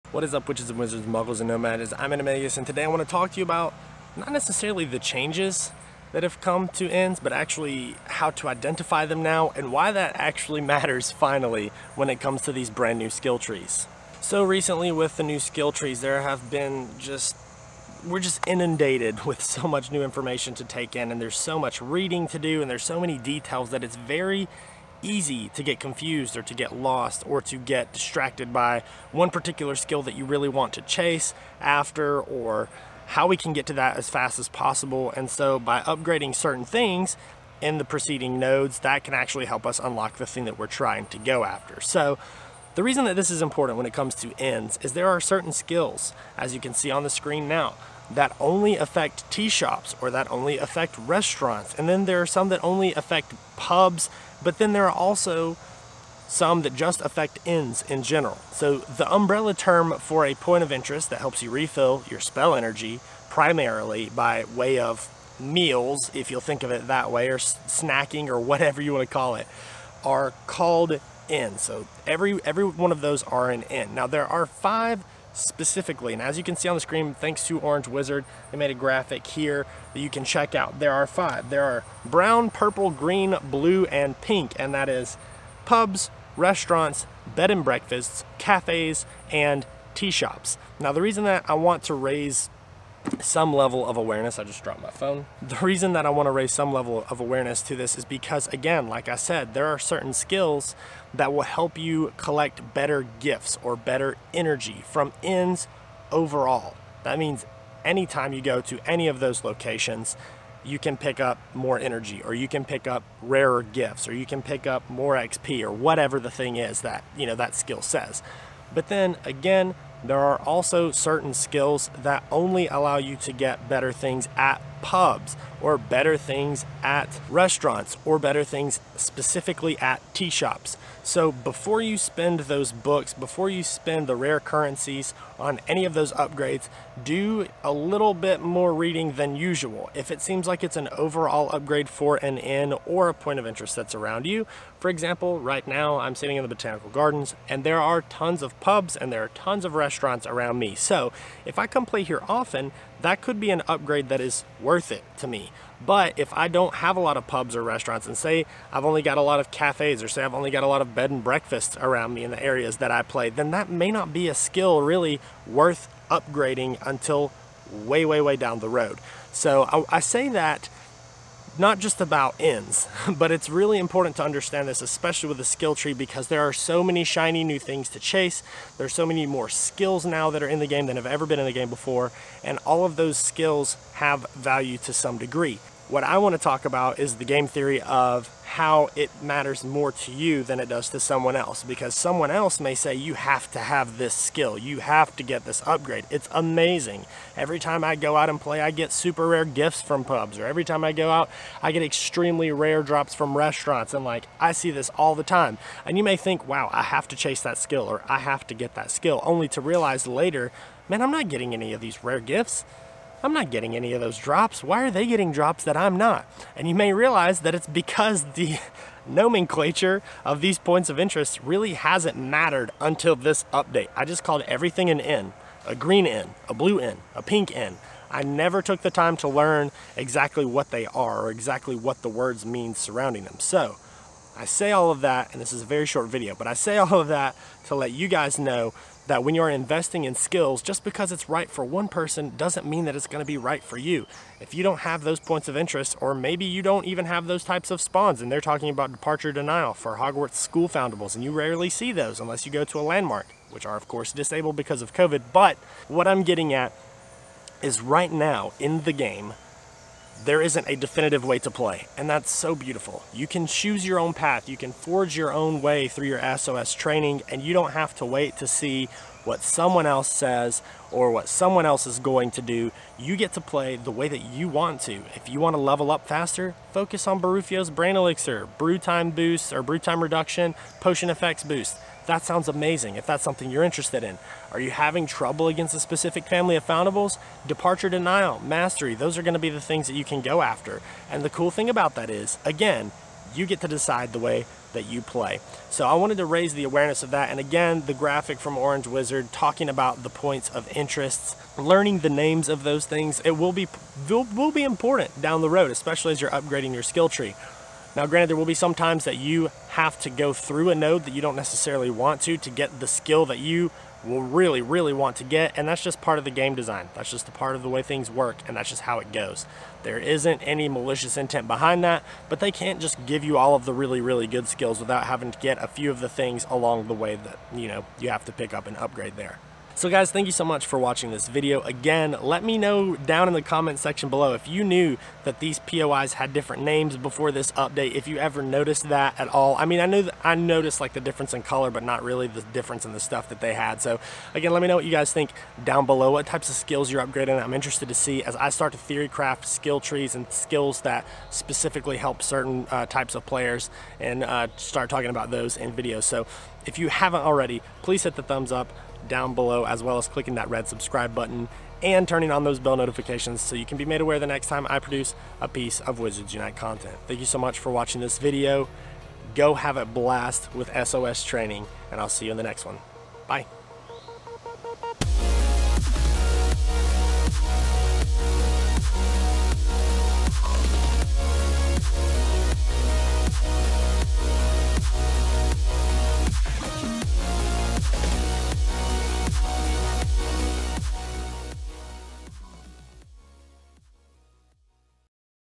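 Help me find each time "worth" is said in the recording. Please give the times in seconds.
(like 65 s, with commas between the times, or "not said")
154 s, 165 s.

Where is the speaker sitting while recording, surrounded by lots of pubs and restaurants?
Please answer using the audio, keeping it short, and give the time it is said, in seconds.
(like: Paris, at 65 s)
Botanical Gardens, at 146 s.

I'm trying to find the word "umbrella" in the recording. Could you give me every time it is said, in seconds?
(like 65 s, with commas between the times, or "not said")
59 s.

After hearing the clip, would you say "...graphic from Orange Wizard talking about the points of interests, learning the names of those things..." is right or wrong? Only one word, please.
right.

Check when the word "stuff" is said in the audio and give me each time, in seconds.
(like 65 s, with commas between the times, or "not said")
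342 s.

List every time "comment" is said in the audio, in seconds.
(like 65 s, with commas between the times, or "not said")
333 s.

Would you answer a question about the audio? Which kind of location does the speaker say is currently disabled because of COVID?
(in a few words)
landmark.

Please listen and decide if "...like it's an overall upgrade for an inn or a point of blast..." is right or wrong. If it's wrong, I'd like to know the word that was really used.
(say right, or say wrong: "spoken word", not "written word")
wrong: "interest", not "blast".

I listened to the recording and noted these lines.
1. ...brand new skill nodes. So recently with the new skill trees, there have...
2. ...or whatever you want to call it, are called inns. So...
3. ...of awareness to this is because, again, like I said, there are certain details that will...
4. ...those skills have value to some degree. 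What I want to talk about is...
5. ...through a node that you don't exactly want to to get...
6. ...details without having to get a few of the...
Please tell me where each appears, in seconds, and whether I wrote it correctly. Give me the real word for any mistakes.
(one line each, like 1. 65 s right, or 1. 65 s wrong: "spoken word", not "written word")
1. 12 s wrong: "trees", not "nodes"
2. 68 s right
3. 97 s wrong: "skills", not "details"
4. 182 s right
5. 310 s wrong: "necessarily", not "exactly"
6. 324 s wrong: "skills", not "details".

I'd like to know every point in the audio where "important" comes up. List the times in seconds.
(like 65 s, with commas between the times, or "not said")
43 s, 173 s, 304 s.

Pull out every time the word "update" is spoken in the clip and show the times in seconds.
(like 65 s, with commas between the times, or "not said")
223 s, 337 s.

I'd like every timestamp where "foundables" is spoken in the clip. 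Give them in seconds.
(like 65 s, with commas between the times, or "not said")
250 s, 286 s.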